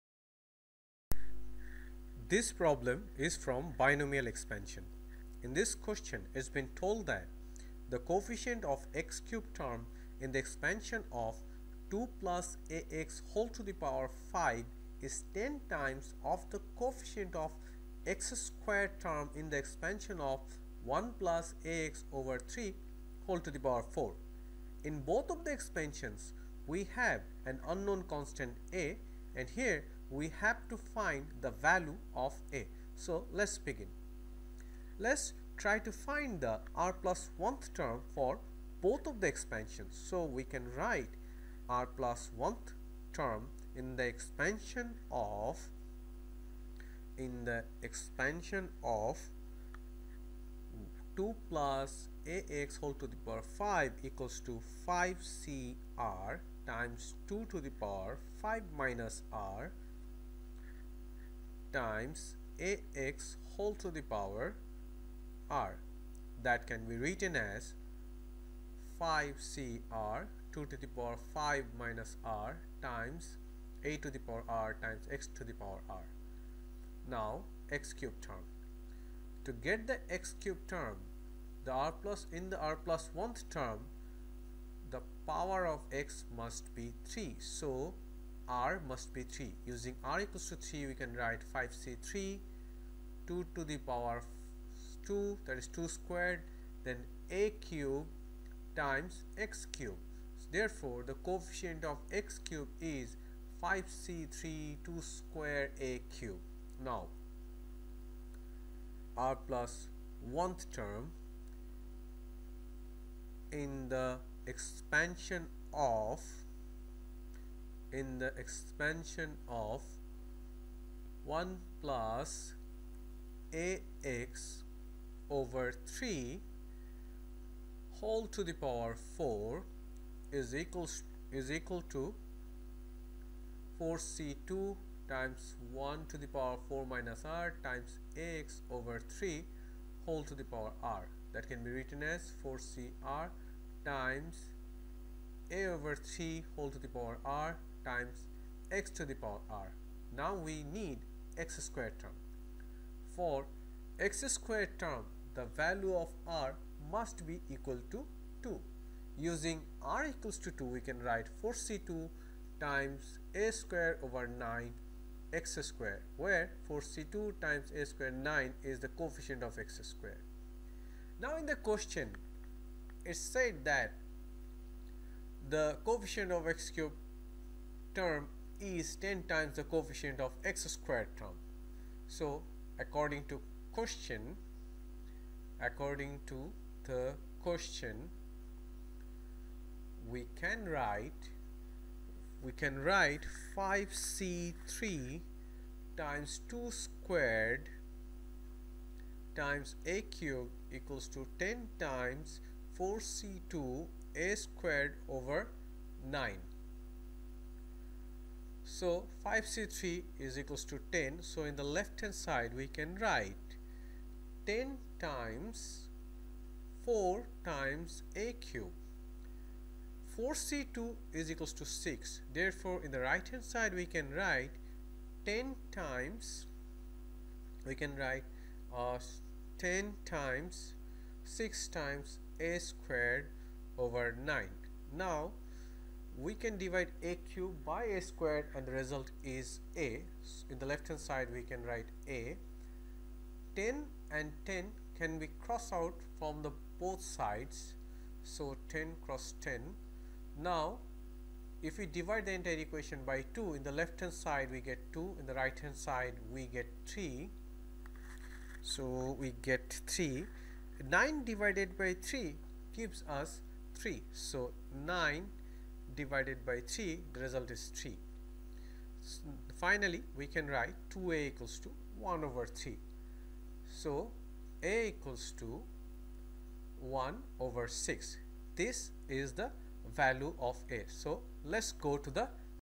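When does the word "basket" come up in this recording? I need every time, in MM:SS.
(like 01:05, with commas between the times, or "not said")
not said.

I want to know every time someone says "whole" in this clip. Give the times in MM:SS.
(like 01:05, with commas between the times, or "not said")
00:13, 00:23, 00:52, 01:03, 02:07, 02:20, 02:26.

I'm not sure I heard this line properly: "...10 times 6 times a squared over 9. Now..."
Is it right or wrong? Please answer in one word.
right.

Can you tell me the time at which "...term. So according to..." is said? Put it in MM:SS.
03:01.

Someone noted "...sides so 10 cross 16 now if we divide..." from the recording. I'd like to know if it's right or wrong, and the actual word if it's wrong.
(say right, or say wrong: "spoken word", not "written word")
wrong: "10", not "16".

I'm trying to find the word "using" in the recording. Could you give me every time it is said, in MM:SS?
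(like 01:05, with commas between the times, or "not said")
01:29, 02:39.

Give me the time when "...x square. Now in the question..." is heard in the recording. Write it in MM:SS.
02:49.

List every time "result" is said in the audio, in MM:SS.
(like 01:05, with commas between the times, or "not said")
03:58, 04:27.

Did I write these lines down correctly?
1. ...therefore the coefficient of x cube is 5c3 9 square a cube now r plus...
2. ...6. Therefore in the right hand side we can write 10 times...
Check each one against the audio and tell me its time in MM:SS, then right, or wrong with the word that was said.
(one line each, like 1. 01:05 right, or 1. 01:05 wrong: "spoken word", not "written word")
1. 01:40 wrong: "2", not "9"
2. 03:41 right.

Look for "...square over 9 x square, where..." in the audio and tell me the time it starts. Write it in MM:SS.
02:43.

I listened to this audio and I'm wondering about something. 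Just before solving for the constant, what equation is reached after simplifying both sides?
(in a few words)
2a = 1/3.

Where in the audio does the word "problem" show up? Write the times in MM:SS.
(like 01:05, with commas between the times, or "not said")
00:02.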